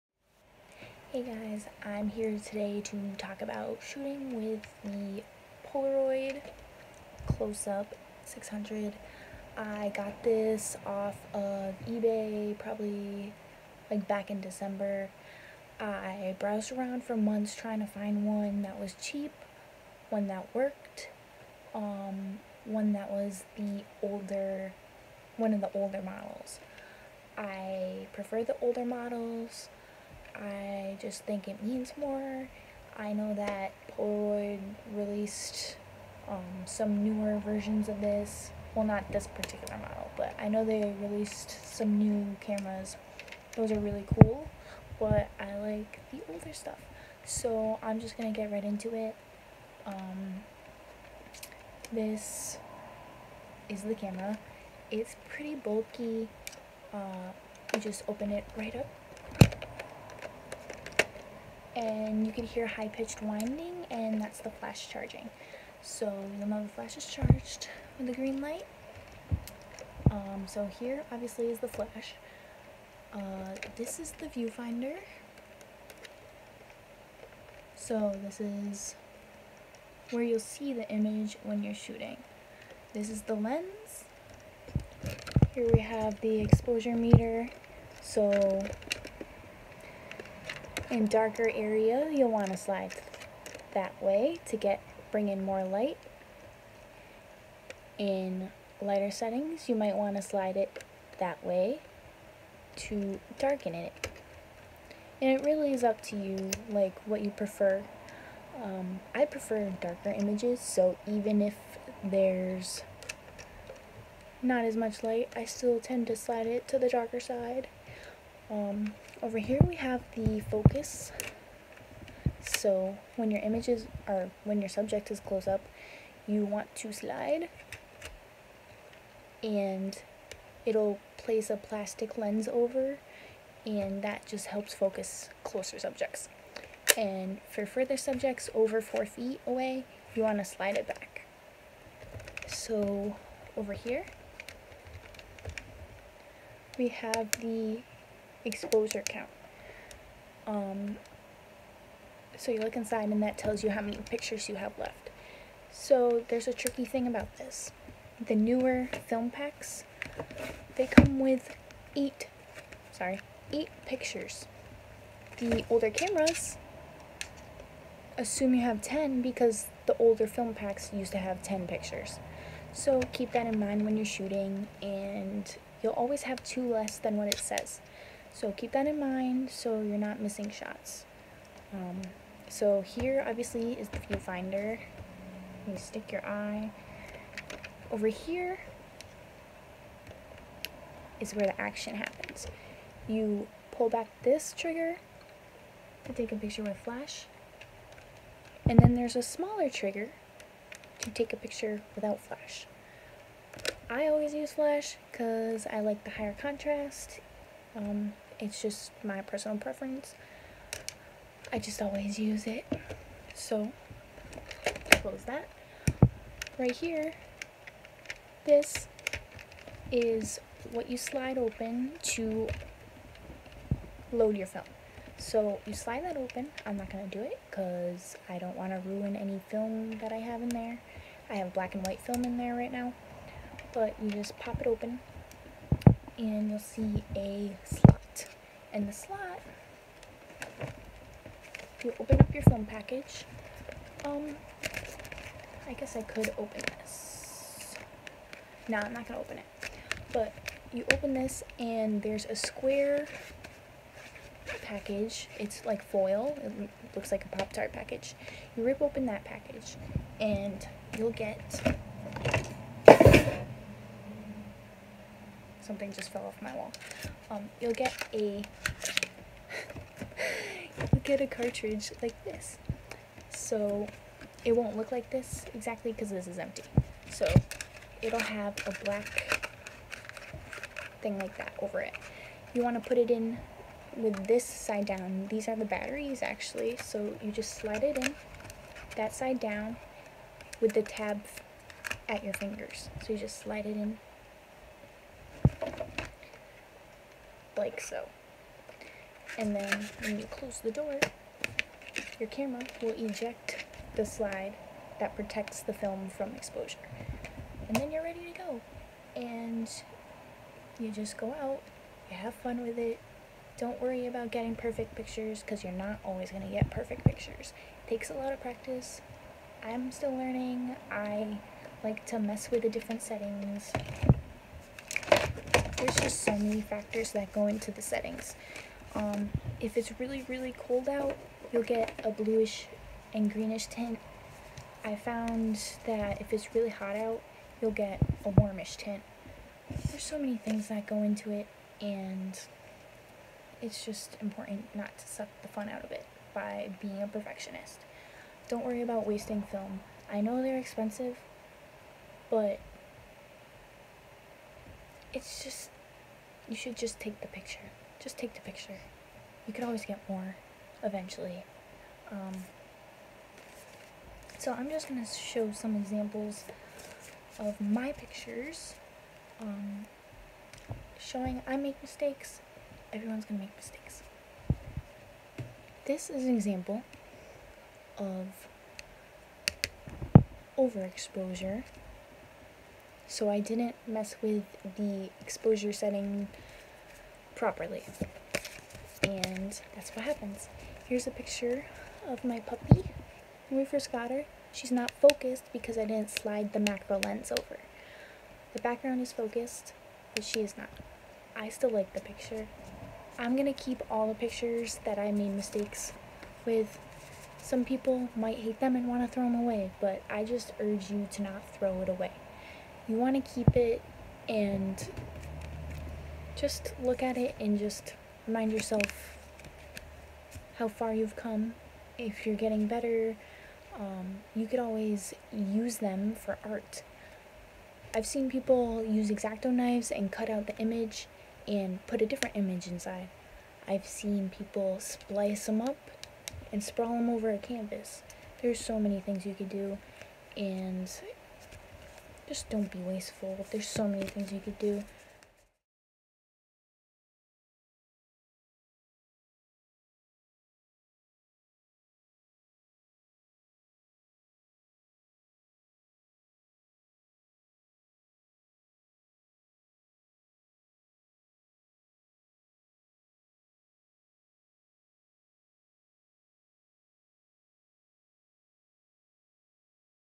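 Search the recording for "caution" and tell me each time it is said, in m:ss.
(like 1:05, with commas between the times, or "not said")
not said.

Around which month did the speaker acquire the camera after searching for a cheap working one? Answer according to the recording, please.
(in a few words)
December.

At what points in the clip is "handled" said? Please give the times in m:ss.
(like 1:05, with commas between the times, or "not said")
not said.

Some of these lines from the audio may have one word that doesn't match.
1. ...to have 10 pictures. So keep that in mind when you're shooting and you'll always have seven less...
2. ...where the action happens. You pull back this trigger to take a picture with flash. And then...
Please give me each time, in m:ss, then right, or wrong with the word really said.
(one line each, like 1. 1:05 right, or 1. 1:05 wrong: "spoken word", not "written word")
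1. 2:51 wrong: "two", not "seven"
2. 3:11 right.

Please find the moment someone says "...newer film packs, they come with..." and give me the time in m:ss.
2:38.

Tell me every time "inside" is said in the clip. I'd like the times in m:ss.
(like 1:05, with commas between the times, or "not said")
2:32, 7:12.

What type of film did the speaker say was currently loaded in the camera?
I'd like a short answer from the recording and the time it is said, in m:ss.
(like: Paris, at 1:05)
black and white, at 3:51.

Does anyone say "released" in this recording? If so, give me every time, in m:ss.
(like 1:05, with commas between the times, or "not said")
0:34, 0:41.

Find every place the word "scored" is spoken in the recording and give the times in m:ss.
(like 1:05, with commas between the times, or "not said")
not said.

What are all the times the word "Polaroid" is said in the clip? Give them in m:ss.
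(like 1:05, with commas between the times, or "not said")
0:05, 0:33.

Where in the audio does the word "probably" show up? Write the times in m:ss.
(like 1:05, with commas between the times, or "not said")
0:12.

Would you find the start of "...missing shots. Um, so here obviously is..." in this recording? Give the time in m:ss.
3:00.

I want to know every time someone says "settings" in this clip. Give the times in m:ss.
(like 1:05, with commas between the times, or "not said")
1:39, 5:23, 5:27, 6:25.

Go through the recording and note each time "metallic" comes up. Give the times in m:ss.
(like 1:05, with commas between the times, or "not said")
not said.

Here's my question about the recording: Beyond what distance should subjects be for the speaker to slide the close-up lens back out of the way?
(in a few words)
4 feet.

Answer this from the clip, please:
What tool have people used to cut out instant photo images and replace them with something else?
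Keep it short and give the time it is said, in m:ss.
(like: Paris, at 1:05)
X-Acto knives, at 7:09.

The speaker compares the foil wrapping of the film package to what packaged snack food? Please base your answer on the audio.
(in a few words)
Pop-Tart.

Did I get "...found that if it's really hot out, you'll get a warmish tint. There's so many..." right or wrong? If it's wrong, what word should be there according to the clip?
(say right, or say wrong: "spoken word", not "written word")
right.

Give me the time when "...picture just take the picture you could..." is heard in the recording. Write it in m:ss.
5:57.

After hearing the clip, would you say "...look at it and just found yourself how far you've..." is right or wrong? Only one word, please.
wrong.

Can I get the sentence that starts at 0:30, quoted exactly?
I just think it means more.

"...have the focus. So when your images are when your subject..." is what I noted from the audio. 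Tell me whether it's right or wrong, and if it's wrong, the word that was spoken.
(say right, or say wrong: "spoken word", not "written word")
right.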